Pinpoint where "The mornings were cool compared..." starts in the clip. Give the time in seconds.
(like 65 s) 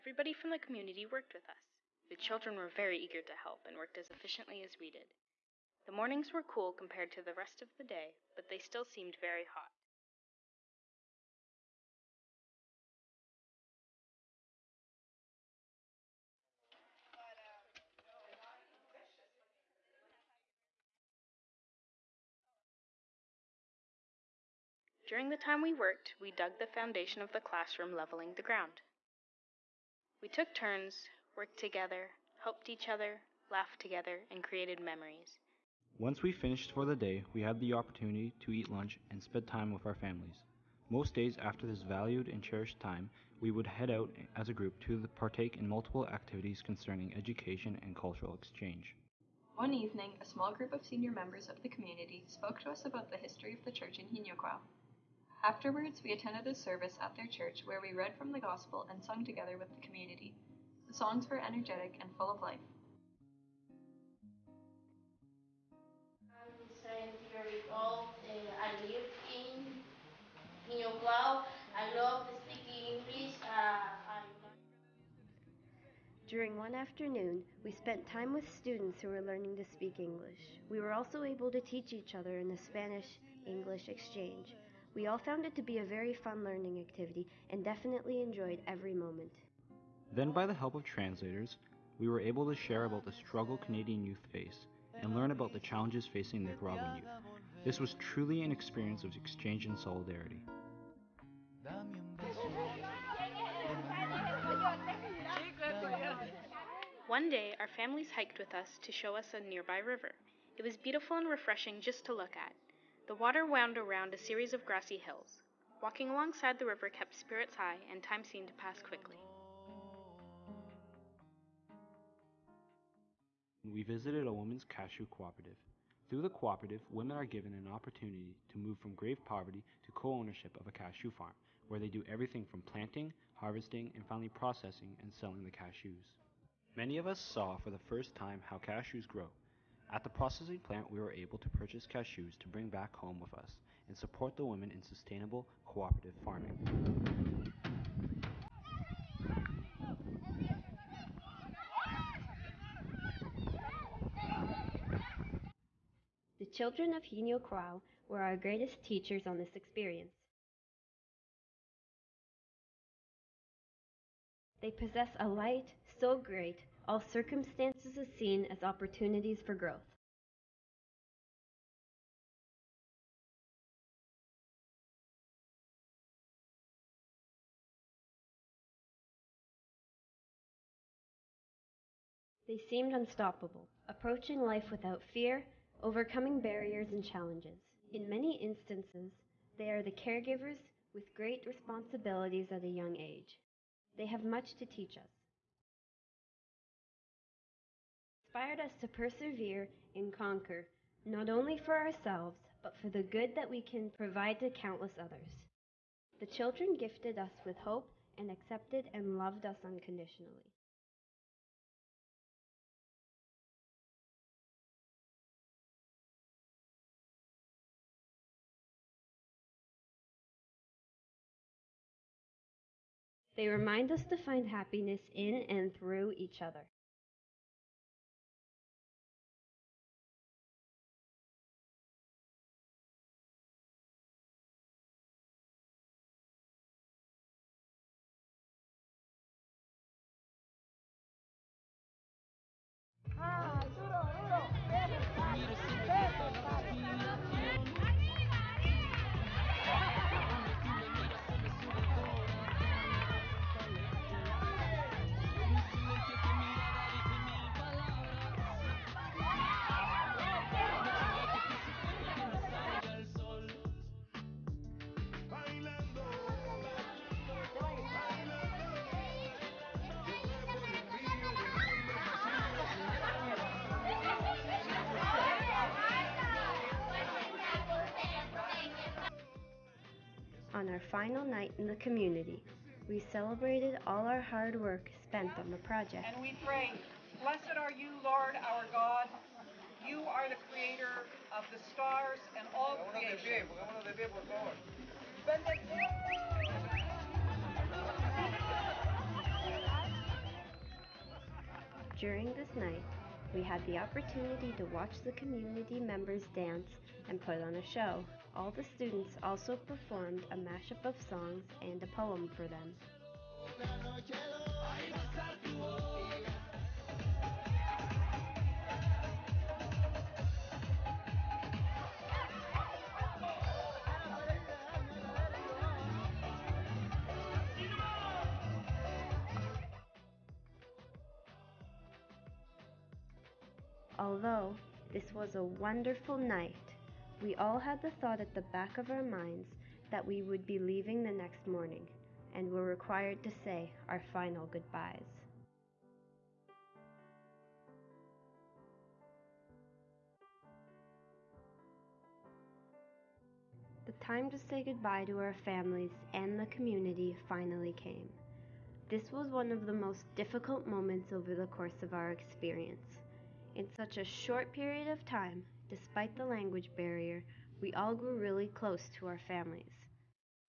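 5 s.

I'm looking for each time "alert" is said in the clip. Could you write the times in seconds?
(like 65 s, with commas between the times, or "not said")
not said.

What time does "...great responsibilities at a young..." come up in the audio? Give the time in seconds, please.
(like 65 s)
191 s.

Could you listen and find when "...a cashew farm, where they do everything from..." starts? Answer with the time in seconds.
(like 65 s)
130 s.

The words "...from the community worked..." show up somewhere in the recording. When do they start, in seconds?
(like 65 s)
0 s.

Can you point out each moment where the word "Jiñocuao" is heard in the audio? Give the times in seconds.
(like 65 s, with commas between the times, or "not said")
54 s, 70 s, 157 s.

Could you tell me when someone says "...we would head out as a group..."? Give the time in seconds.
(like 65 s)
43 s.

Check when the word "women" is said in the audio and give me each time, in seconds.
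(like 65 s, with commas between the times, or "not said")
126 s, 144 s.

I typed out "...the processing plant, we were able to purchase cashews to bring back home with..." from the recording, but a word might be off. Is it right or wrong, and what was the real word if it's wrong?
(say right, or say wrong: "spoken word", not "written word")
right.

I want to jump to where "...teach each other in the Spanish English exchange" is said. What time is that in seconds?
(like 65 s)
81 s.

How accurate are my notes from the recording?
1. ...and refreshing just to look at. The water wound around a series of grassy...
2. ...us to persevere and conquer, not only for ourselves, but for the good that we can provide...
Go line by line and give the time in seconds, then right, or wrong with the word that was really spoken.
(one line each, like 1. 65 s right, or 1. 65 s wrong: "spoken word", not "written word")
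1. 111 s right
2. 198 s right.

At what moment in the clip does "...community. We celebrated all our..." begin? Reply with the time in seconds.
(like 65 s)
281 s.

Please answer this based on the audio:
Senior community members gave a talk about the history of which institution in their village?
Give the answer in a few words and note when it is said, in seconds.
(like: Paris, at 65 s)
The church, at 53 s.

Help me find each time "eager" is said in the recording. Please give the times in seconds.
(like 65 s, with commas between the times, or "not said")
2 s.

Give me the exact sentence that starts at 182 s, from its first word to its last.
They seemed unstoppable, approaching life without fear, overcoming barriers and challenges.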